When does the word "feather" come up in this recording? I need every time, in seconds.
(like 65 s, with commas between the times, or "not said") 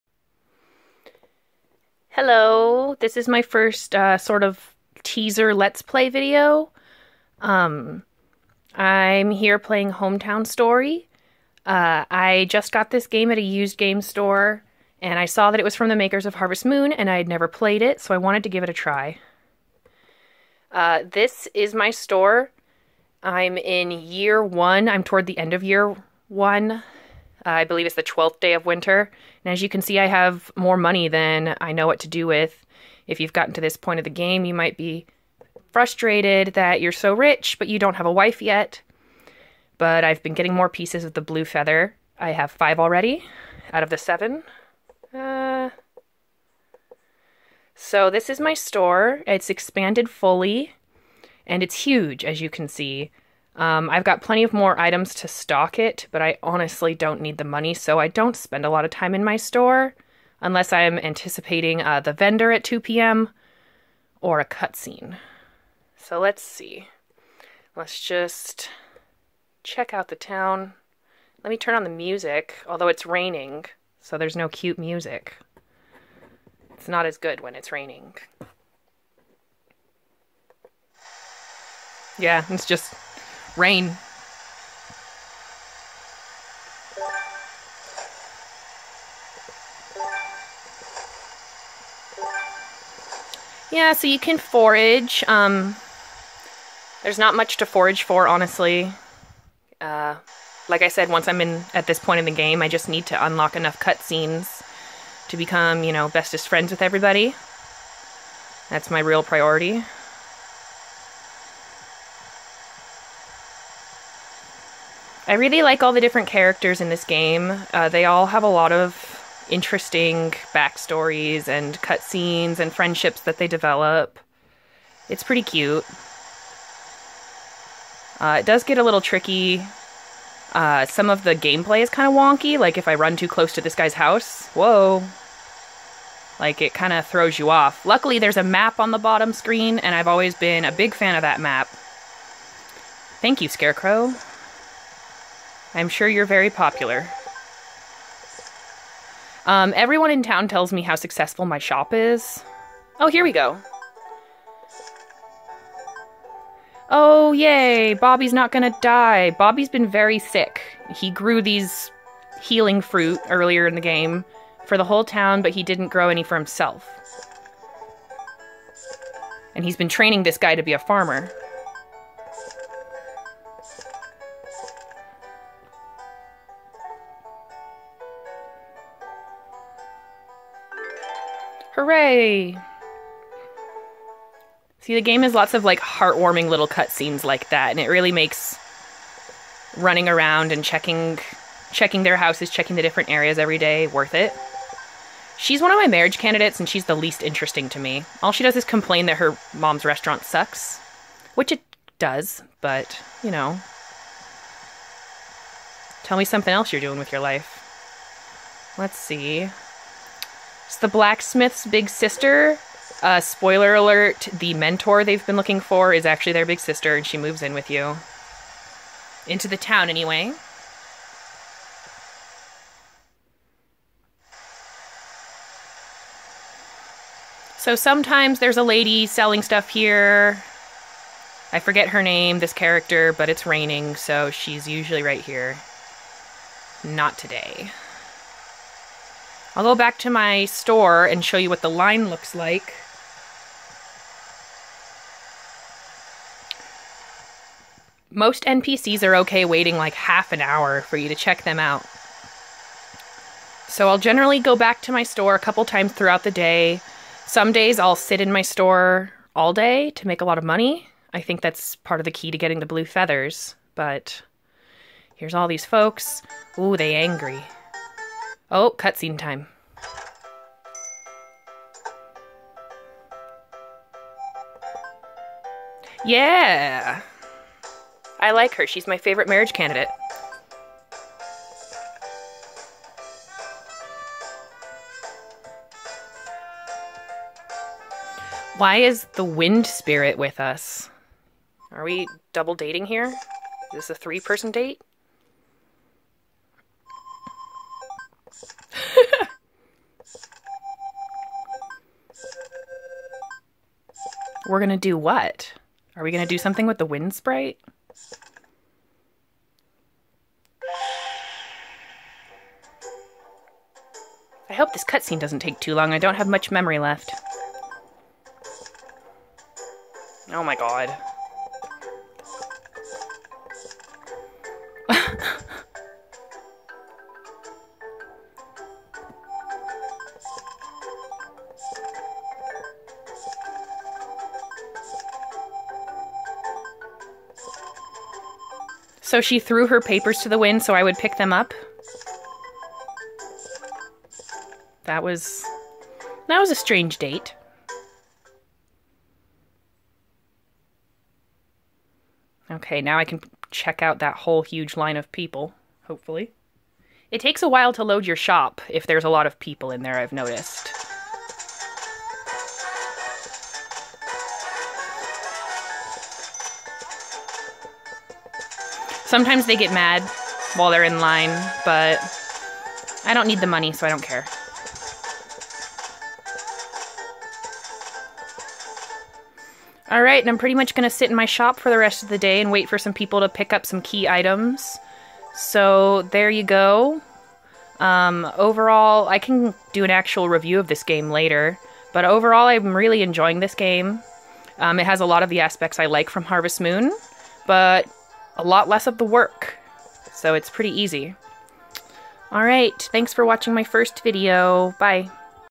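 41 s, 262 s.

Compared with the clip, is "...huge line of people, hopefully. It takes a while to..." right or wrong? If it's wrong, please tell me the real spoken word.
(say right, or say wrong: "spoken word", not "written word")
right.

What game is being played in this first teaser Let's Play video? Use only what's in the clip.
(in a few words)
Hometown Story.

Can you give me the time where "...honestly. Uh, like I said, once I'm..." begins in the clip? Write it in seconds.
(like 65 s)
98 s.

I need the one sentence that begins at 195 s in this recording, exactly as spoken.
She's one of my marriage candidates and she's the least interesting to me.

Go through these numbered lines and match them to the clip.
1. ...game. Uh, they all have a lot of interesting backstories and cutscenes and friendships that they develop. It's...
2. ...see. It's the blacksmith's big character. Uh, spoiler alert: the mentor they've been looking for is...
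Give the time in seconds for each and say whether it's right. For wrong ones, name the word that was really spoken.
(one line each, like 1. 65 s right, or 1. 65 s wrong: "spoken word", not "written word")
1. 117 s right
2. 208 s wrong: "sister", not "character".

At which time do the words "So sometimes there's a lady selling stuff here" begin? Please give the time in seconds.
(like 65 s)
227 s.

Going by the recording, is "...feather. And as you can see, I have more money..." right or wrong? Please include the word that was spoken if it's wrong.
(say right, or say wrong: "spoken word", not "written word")
wrong: "winter", not "feather".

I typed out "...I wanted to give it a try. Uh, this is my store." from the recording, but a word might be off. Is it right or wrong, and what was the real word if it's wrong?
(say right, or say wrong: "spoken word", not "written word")
right.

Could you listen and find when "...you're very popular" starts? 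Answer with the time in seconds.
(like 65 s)
146 s.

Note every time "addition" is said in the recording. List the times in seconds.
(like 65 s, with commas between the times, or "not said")
not said.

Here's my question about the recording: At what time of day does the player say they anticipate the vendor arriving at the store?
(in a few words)
2 p.m.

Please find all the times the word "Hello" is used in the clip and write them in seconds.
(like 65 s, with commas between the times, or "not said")
2 s.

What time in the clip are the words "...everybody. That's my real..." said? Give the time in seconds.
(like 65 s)
106 s.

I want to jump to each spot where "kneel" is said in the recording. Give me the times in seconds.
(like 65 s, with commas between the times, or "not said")
not said.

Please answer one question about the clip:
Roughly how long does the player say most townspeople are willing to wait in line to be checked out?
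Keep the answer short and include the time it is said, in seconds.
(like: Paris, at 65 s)
half an hour, at 249 s.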